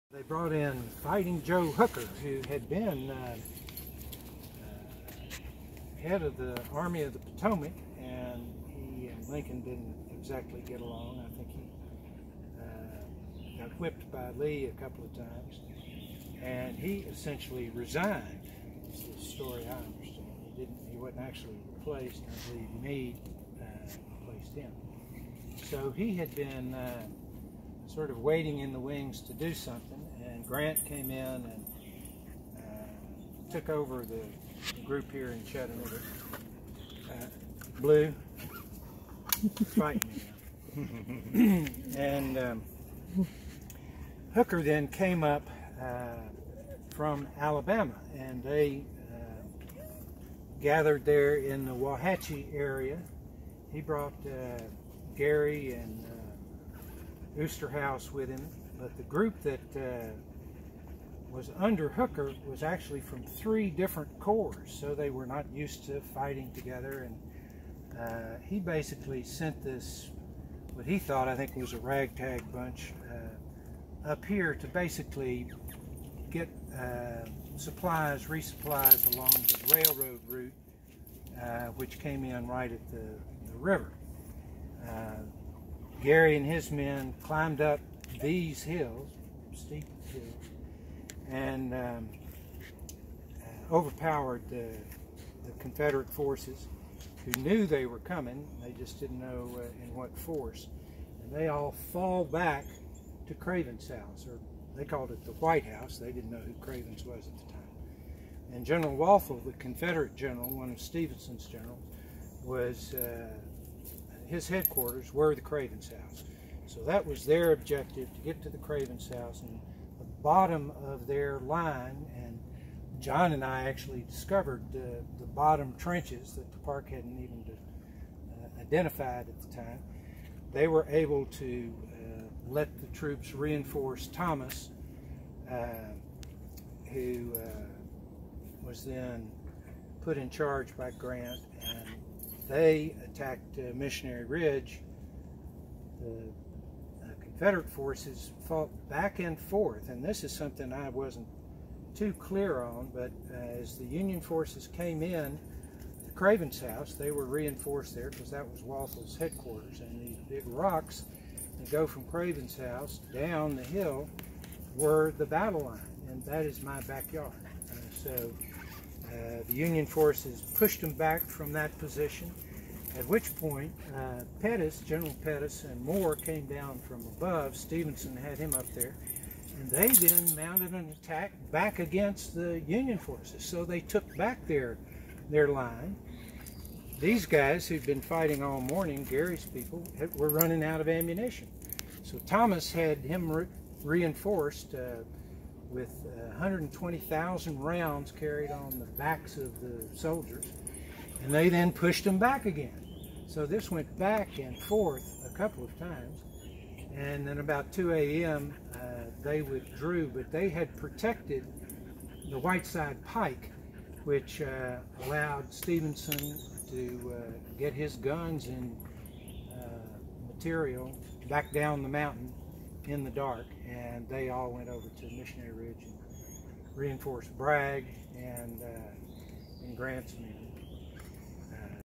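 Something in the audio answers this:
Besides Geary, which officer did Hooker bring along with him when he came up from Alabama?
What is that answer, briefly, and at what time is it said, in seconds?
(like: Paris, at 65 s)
Osterhaus, at 57 s.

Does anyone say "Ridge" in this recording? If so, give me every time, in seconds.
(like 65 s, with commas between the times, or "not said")
144 s, 225 s.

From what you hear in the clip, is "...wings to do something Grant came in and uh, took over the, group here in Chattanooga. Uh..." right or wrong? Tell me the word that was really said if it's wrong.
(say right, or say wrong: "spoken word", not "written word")
right.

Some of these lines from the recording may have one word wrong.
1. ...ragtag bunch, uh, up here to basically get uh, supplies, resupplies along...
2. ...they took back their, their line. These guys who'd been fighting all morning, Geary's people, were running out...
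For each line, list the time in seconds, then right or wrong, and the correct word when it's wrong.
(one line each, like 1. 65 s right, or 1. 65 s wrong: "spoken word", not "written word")
1. 71 s right
2. 183 s right.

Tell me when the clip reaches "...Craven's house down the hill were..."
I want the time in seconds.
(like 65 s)
162 s.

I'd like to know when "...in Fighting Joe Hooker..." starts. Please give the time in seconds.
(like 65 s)
0 s.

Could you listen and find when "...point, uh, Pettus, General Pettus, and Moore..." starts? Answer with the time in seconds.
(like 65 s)
173 s.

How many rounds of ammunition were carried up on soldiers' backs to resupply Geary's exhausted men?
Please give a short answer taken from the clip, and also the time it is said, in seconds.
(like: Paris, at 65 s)
120,000, at 196 s.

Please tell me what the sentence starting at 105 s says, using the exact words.
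They didn't know who Craven's was at the time.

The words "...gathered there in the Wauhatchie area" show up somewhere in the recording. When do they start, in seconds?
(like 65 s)
50 s.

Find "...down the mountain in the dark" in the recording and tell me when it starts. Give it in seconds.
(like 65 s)
221 s.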